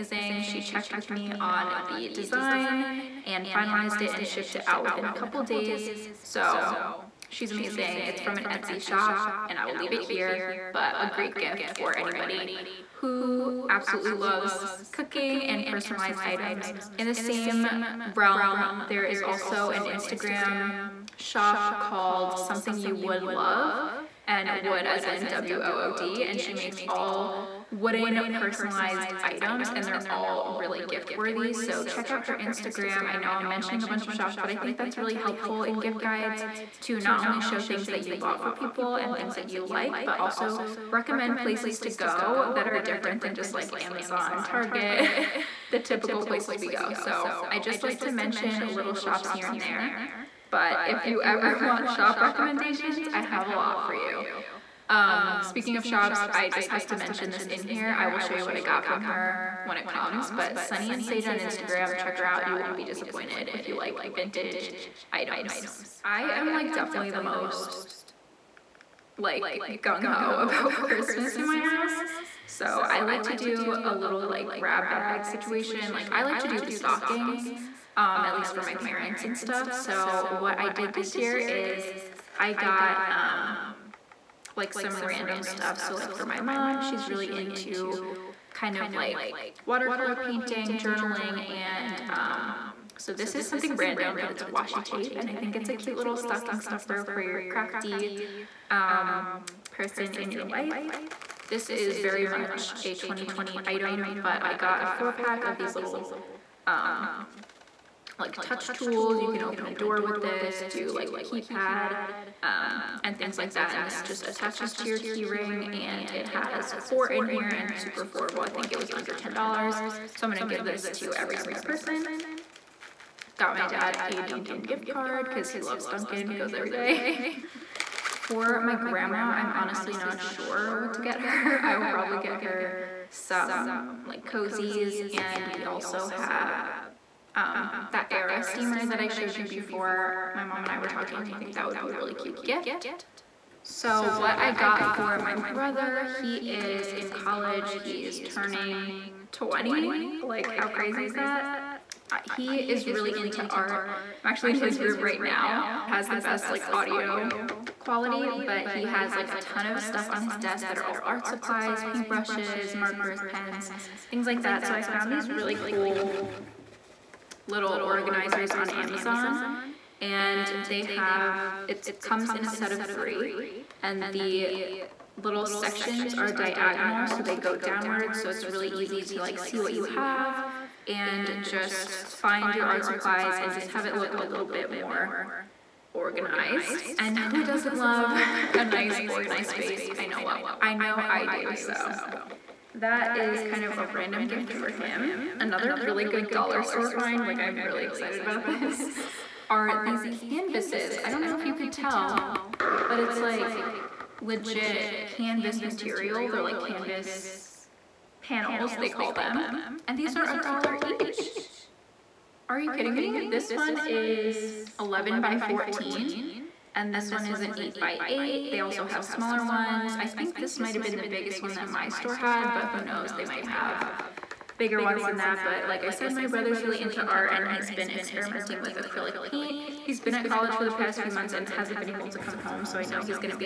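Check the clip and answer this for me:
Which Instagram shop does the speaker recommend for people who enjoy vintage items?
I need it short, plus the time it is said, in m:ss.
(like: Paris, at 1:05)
Sunny and Sage, at 1:00.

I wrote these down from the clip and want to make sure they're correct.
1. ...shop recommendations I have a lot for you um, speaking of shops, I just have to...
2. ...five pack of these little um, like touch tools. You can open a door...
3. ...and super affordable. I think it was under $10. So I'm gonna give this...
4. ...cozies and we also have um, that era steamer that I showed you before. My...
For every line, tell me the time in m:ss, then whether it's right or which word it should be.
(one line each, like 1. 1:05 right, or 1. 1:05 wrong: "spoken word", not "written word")
1. 0:51 right
2. 1:44 wrong: "four", not "five"
3. 1:57 right
4. 2:14 right.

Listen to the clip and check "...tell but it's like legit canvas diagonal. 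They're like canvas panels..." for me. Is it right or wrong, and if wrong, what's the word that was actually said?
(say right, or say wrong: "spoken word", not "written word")
wrong: "material", not "diagonal".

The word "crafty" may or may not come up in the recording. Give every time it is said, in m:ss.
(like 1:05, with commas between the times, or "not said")
1:37.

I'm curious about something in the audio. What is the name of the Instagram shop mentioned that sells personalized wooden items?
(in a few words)
Something You Wood Love.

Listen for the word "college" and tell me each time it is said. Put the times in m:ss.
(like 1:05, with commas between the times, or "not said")
2:27, 3:50.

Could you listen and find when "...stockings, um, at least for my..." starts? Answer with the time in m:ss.
1:16.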